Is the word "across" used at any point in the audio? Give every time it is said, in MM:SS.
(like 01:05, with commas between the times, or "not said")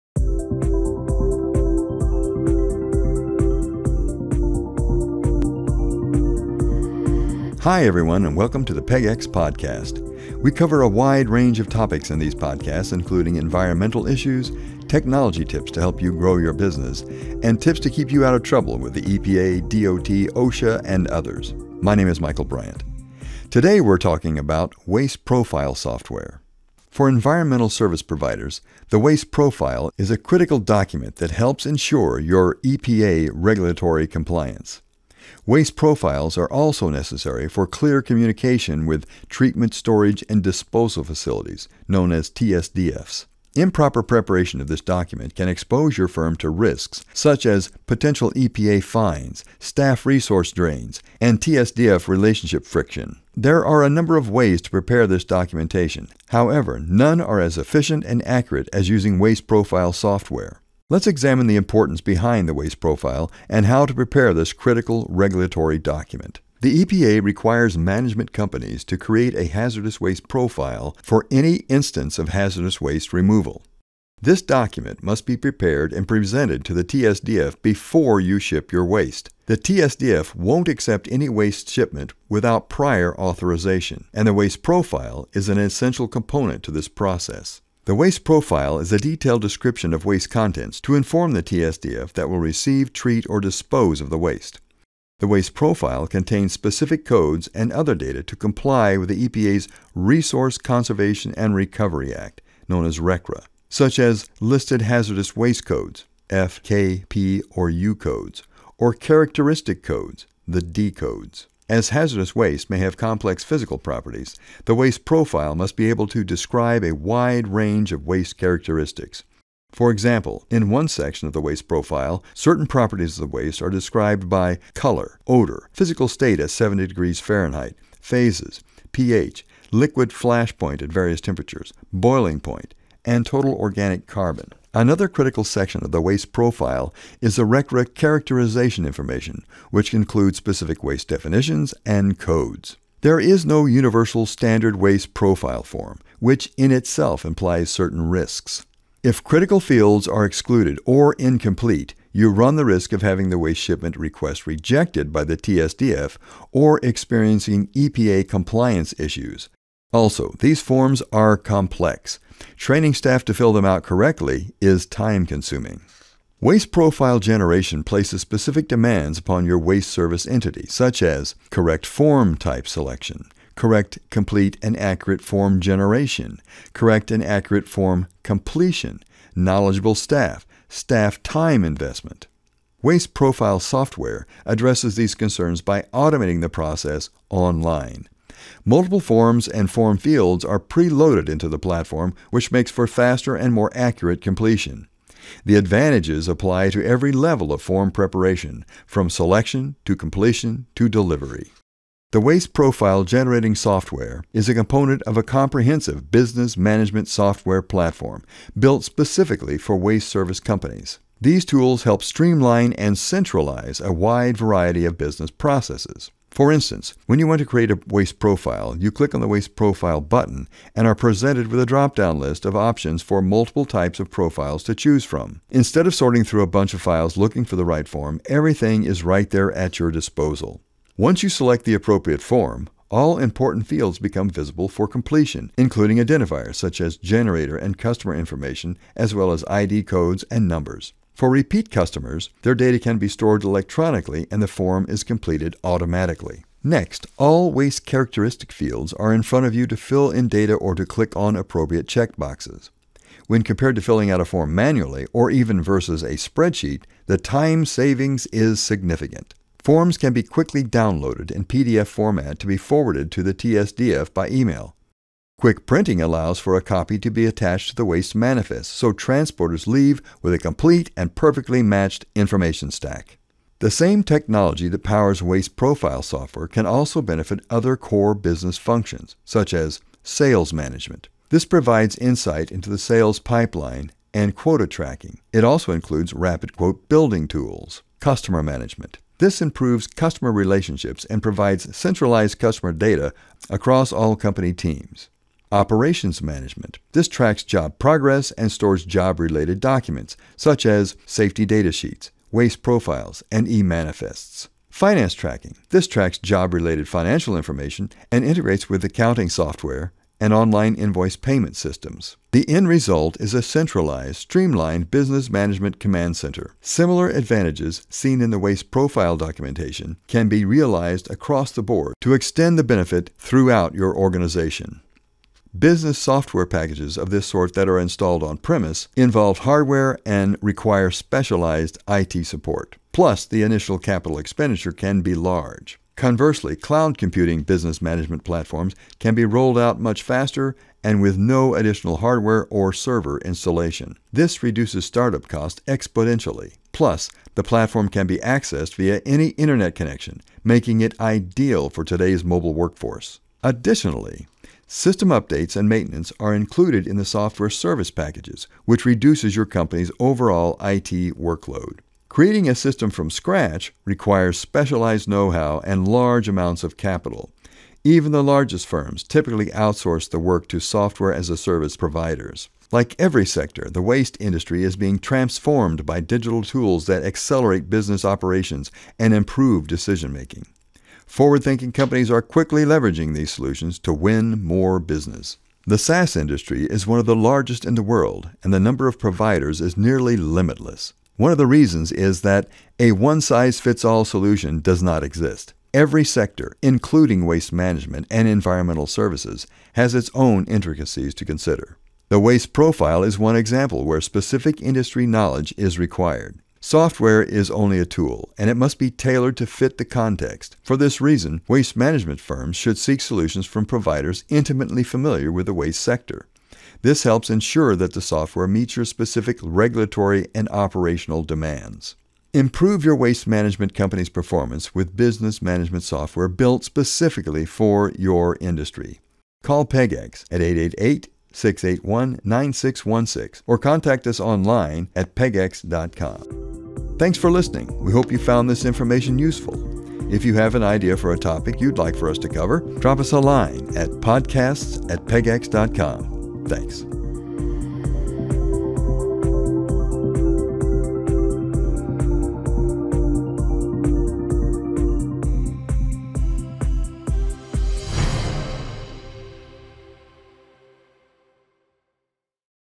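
04:53, 05:21.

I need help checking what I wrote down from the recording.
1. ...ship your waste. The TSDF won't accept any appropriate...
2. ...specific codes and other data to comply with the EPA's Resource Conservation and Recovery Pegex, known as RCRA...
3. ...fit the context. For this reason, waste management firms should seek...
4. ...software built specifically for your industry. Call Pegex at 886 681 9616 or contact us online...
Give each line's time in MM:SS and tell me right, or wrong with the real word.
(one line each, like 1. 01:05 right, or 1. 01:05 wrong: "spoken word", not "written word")
1. 01:18 wrong: "waste", not "appropriate"
2. 01:36 wrong: "Act", not "Pegex"
3. 06:49 right
4. 07:05 wrong: "888", not "886".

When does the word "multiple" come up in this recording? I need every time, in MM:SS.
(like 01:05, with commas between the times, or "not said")
03:08, 03:43.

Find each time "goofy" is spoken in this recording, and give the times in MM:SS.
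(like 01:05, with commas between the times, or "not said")
not said.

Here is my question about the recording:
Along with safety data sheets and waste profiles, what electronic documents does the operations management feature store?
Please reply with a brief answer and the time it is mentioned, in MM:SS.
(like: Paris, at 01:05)
e-manifests, at 05:03.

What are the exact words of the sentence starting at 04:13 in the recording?
When compared to filling out a form manually or even versus a spreadsheet, the time savings is significant.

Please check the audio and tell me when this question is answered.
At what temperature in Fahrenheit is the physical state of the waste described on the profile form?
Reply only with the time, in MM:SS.
02:06.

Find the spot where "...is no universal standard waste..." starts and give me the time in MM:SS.
02:23.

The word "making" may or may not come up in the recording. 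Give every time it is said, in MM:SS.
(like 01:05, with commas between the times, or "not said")
05:50, 06:20.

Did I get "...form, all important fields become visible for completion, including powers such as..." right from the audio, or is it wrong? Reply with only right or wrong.
wrong.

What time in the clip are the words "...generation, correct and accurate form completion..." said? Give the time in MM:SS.
02:55.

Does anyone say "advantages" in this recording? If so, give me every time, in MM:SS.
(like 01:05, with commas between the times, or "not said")
03:15, 05:17.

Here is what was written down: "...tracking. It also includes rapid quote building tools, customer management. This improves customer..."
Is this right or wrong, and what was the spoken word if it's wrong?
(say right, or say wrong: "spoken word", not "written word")
right.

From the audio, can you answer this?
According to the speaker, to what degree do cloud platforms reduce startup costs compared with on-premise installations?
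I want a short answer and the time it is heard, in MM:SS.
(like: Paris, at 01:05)
exponentially, at 05:45.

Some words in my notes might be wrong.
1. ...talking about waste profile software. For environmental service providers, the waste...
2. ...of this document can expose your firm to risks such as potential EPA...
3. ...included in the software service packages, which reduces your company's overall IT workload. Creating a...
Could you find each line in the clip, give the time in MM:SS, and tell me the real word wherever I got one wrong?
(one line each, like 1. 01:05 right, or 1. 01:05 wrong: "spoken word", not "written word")
1. 00:23 right
2. 00:44 right
3. 05:56 right.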